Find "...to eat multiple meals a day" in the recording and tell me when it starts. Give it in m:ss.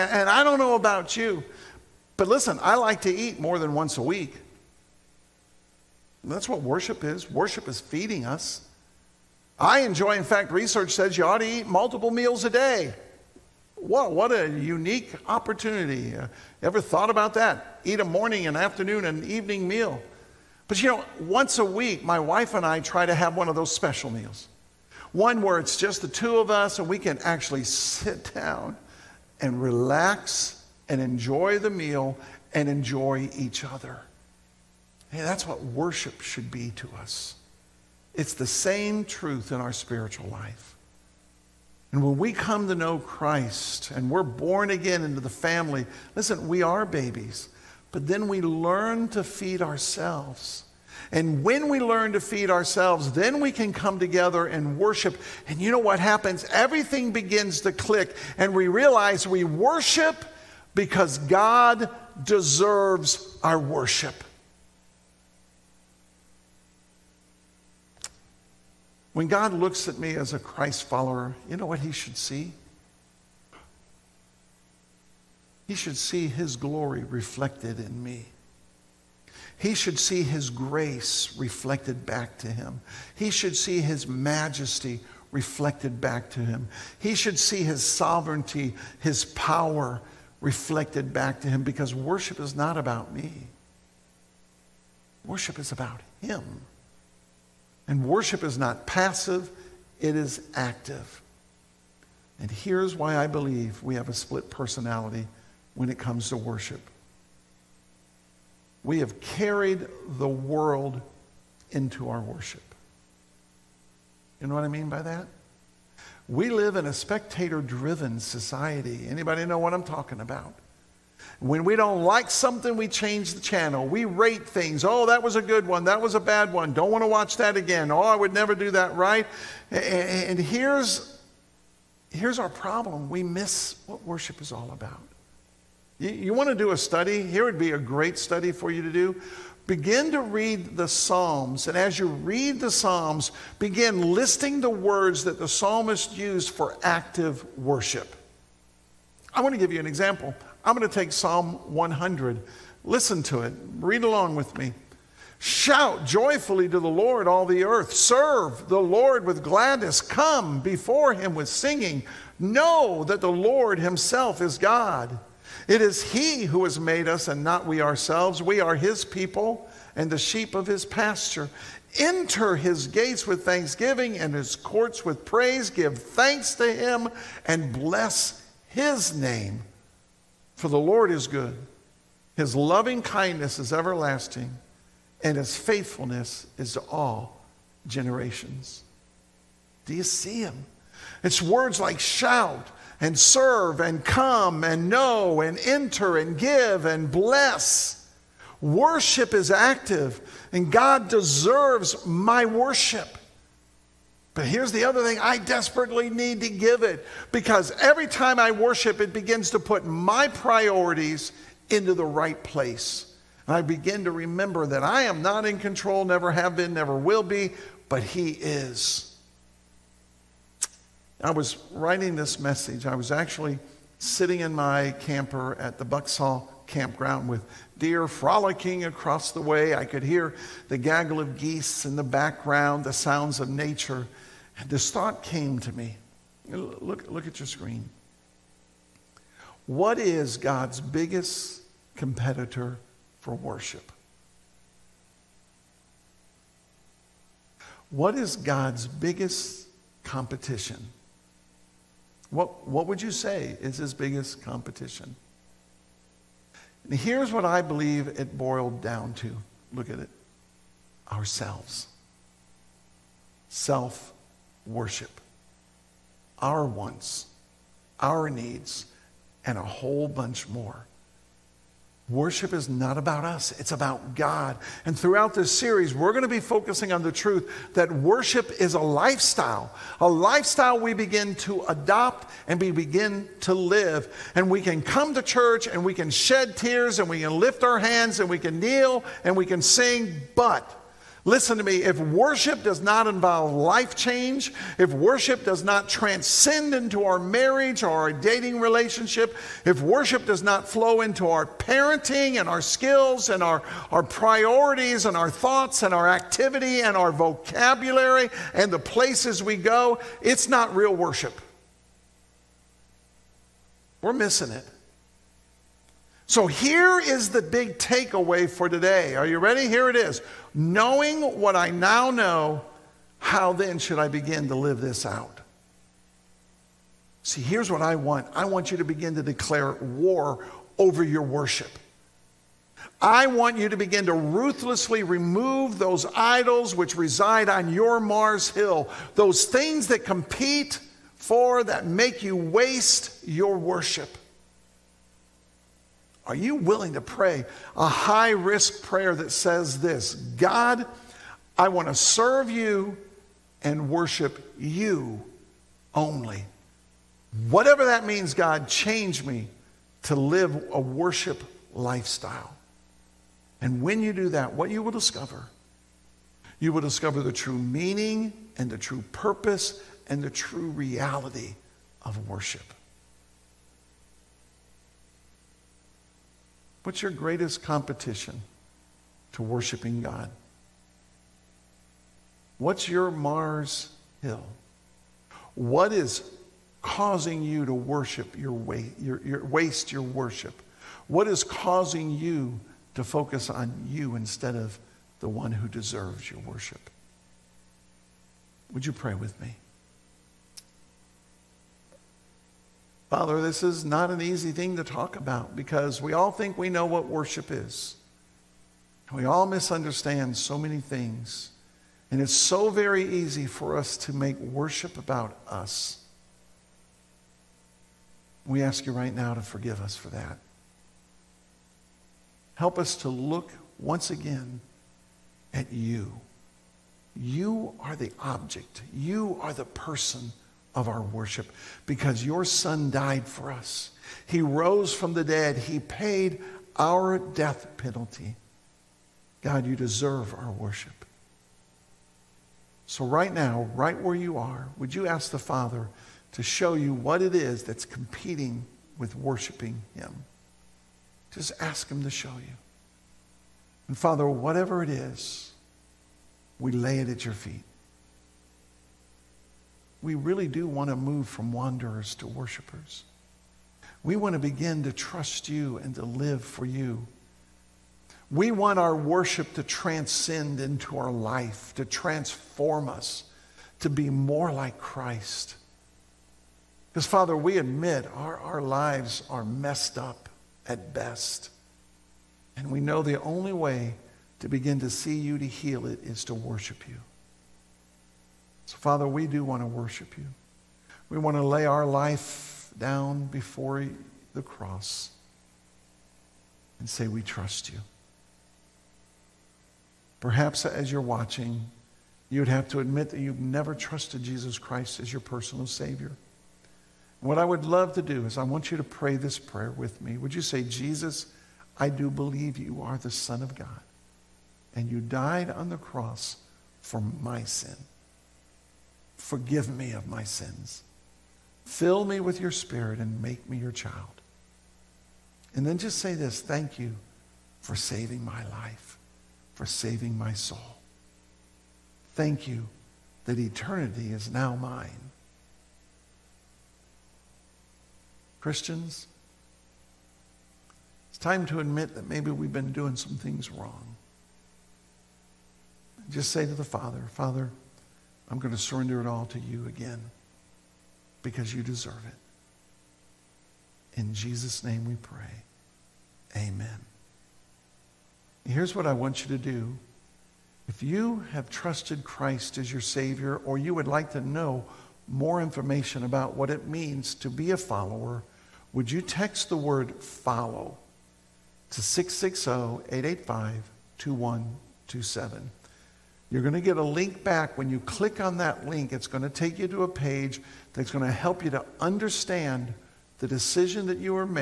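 0:11.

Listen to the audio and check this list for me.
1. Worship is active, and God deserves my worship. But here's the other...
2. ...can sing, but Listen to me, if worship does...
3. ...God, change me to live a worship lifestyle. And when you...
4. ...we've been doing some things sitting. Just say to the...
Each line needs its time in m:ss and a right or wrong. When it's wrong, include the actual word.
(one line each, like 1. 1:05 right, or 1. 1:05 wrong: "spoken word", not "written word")
1. 3:18 right
2. 4:49 right
3. 5:58 right
4. 9:02 wrong: "wrong", not "sitting".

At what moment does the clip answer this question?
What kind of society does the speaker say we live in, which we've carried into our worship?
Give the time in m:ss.
1:56.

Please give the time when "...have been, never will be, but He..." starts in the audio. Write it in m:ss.
3:36.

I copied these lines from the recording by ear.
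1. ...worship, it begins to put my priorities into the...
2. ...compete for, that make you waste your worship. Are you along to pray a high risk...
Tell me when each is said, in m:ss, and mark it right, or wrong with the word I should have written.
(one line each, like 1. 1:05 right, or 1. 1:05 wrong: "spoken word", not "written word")
1. 3:28 right
2. 5:40 wrong: "willing", not "along".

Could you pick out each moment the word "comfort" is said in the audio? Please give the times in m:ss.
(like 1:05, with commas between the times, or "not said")
not said.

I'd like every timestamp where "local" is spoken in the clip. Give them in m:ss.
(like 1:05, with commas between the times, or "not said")
not said.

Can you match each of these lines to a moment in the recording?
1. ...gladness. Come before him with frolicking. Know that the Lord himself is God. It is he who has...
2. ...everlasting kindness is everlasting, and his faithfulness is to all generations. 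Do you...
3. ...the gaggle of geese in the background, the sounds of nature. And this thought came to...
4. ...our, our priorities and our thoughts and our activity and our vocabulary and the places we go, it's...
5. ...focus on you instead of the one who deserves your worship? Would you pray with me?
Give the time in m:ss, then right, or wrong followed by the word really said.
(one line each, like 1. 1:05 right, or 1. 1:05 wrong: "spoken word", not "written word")
1. 2:39 wrong: "singing", not "frolicking"
2. 3:02 wrong: "loving", not "everlasting"
3. 3:50 right
4. 5:03 right
5. 6:33 right.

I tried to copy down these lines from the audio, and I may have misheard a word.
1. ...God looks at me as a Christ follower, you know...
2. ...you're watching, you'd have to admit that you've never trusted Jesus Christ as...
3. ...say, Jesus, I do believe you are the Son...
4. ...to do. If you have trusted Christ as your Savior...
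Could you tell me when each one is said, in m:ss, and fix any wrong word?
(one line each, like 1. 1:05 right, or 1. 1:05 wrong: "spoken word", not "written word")
1. 1:09 right
2. 8:20 right
3. 8:30 right
4. 9:19 right.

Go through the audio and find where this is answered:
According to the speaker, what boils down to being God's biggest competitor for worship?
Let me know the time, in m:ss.
4:23.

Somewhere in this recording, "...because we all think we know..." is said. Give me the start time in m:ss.
6:45.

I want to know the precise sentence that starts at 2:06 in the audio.
Don't want to watch that again.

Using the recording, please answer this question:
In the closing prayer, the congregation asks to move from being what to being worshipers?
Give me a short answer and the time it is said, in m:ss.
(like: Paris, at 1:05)
wanderers, at 7:41.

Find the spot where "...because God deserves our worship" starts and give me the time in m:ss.
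1:00.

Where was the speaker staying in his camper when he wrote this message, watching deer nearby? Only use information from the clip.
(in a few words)
Bucksaw campground.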